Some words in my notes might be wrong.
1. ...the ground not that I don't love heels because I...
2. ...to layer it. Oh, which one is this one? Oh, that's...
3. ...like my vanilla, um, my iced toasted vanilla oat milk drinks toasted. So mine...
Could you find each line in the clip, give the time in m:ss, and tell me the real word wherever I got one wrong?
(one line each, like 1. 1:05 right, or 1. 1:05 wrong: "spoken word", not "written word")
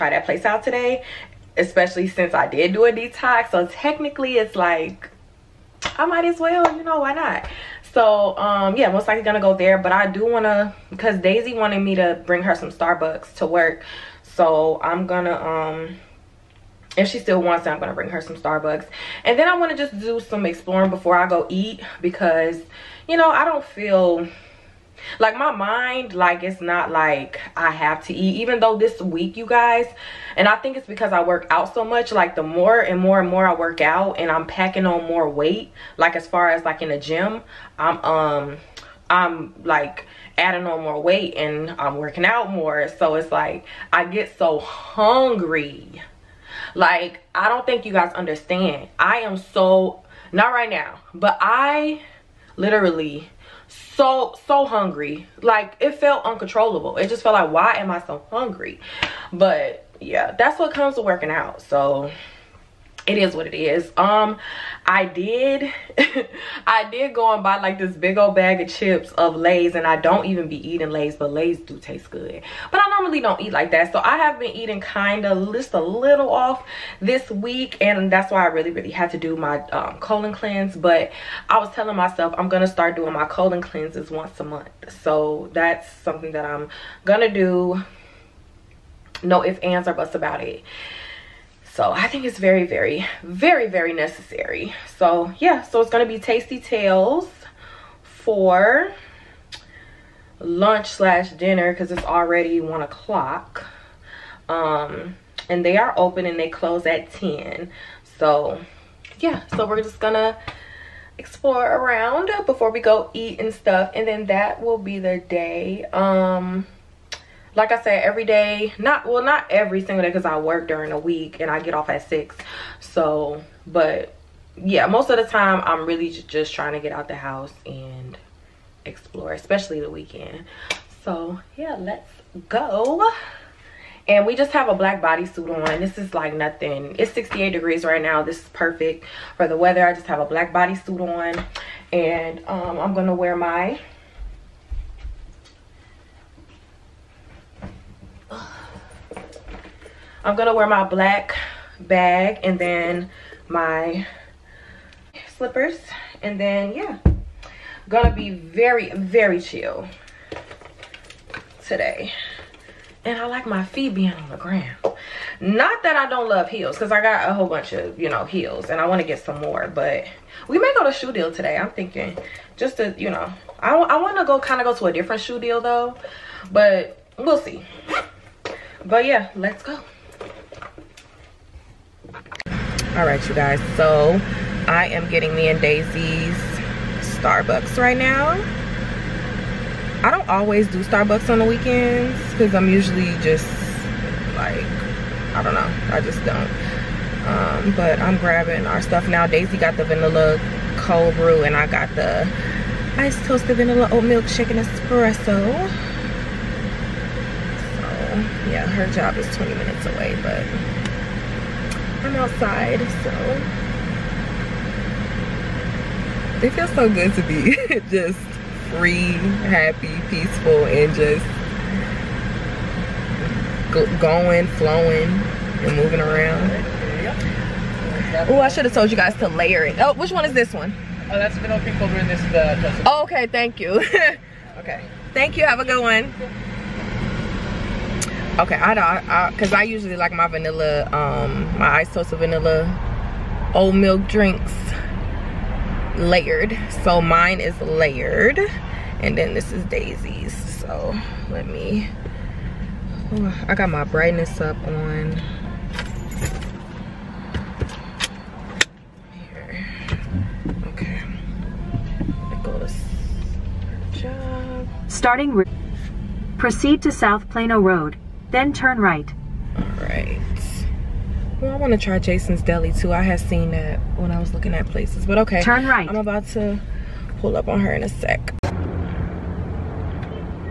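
1. 2:44 right
2. 3:49 right
3. 3:59 wrong: "layered", not "toasted".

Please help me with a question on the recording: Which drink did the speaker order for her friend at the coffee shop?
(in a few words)
vanilla cold brew.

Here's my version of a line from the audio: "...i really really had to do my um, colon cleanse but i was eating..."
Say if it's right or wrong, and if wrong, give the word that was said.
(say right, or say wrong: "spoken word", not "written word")
wrong: "telling", not "eating".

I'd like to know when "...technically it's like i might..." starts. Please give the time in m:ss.
0:03.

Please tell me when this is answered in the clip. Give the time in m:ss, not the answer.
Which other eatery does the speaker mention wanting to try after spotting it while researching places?
4:31.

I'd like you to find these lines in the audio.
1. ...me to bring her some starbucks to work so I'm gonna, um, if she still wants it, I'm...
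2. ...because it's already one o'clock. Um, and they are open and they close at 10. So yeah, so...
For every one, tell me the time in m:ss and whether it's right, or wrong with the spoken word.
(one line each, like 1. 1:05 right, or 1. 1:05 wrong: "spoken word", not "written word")
1. 0:11 right
2. 1:41 right.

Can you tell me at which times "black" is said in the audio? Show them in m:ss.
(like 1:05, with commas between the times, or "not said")
2:14, 2:20, 2:30.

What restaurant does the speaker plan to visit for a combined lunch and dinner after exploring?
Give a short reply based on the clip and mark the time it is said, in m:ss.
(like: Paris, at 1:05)
Tasty Tales, at 1:36.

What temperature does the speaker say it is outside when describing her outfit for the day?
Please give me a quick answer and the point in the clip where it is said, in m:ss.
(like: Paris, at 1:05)
68 degrees, at 2:17.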